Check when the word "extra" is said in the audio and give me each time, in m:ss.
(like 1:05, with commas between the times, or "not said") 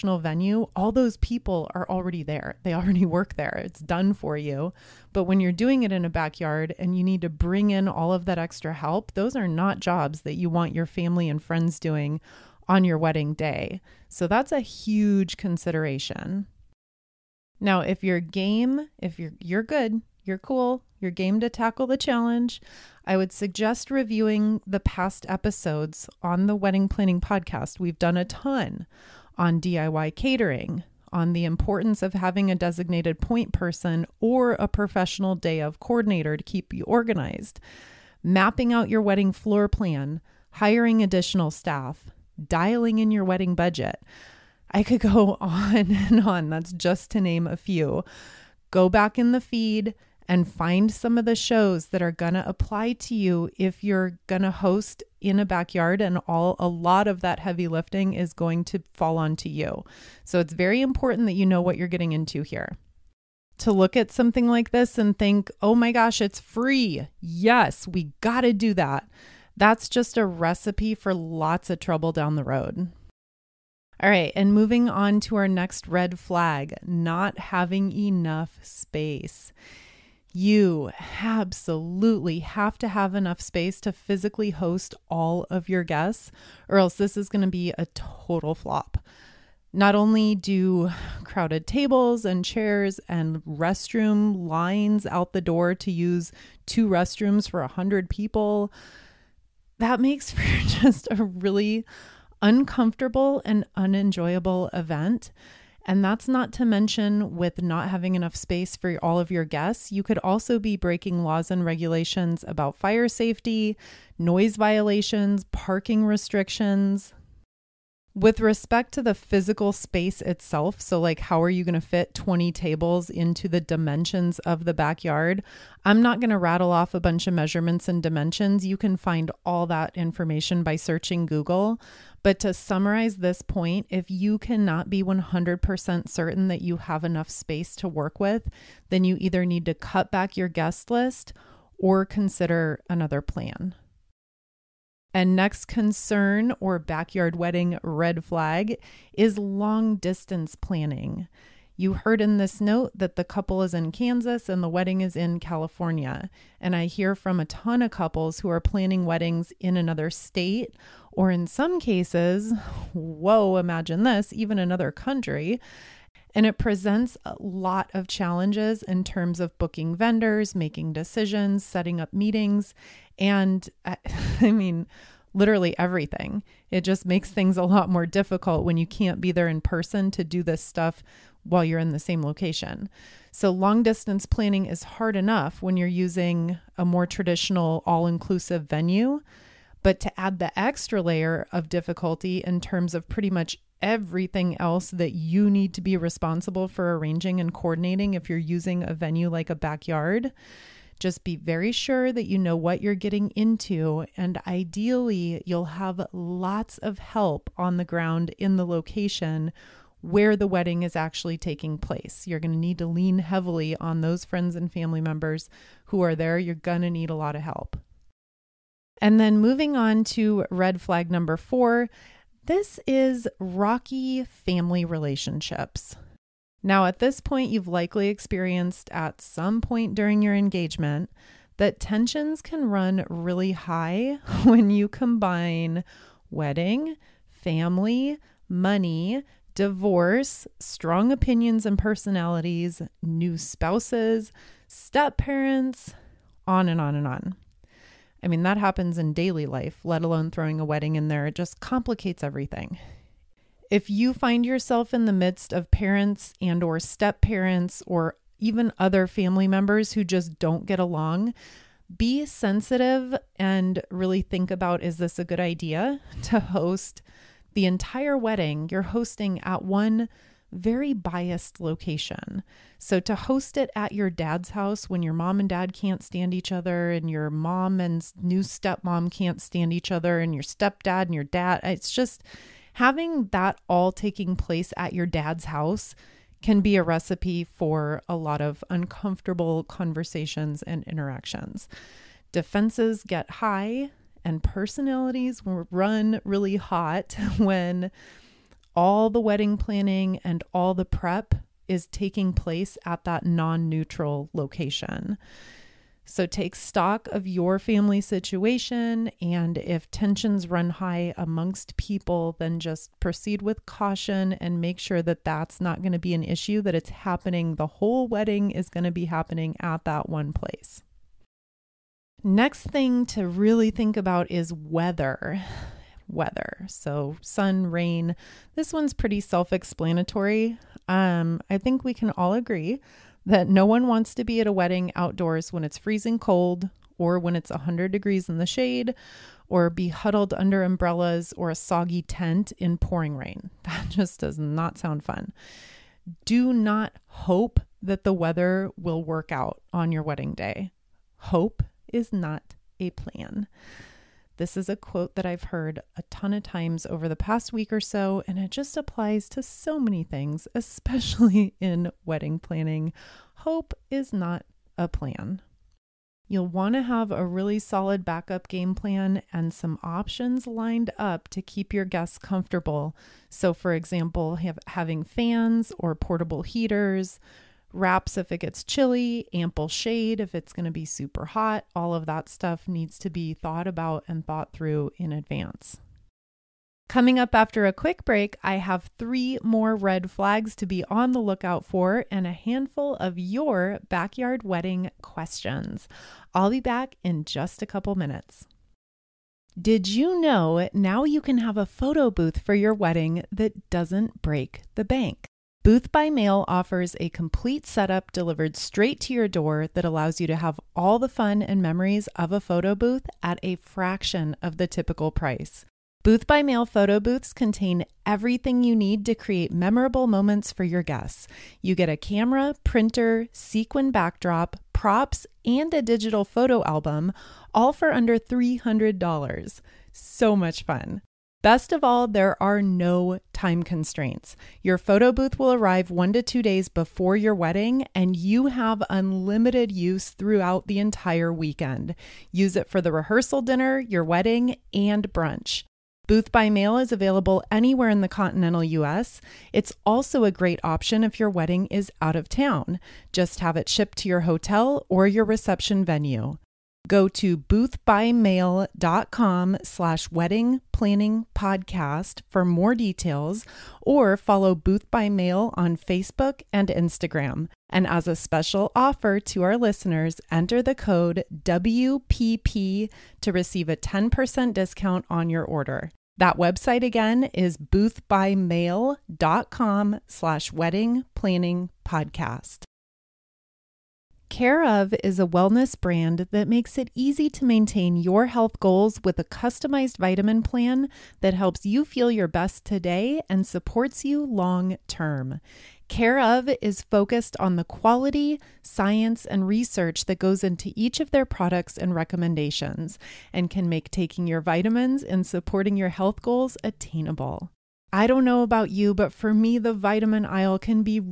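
0:08, 3:10.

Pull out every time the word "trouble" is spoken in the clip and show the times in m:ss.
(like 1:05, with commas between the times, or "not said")
1:11.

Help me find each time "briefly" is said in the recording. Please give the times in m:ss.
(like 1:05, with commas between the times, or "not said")
not said.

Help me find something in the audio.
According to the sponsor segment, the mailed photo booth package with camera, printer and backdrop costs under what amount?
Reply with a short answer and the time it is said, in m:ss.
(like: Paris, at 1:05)
$300, at 7:08.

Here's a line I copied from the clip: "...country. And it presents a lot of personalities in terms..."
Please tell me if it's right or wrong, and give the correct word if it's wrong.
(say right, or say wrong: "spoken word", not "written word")
wrong: "challenges", not "personalities".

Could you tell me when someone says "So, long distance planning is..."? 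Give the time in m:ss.
3:03.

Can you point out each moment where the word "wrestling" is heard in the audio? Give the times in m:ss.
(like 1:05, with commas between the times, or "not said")
not said.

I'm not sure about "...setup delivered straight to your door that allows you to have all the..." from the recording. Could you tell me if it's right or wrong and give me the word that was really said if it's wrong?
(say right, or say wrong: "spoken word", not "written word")
right.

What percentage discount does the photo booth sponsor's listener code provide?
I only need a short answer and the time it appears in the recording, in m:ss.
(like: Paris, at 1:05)
10%, at 7:53.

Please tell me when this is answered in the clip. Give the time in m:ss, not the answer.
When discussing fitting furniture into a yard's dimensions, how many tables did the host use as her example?
2:02.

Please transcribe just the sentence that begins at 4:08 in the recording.
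I mean, that happens in daily life, let alone throwing a wedding in there.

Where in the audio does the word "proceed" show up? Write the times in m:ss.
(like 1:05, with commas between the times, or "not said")
5:12.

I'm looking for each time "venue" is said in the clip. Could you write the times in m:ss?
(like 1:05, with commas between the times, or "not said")
0:00, 3:08, 3:18, 7:35.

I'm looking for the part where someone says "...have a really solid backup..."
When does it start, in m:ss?
6:06.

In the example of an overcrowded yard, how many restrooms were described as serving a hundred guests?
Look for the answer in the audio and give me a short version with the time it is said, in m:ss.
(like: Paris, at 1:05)
2, at 1:36.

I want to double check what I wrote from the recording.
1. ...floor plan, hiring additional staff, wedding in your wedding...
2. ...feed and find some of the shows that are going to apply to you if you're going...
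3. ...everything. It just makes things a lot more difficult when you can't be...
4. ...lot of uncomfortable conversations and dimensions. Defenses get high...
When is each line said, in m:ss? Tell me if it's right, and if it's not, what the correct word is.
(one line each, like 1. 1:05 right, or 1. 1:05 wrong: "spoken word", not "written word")
1. 0:39 wrong: "dialing", not "wedding"
2. 0:49 right
3. 2:55 right
4. 4:48 wrong: "interactions", not "dimensions".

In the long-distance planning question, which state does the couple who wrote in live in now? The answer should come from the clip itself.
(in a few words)
Kansas.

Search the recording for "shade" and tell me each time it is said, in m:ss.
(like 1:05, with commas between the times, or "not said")
5:38, 6:19.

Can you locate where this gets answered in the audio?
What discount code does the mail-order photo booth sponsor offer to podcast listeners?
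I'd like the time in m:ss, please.
7:51.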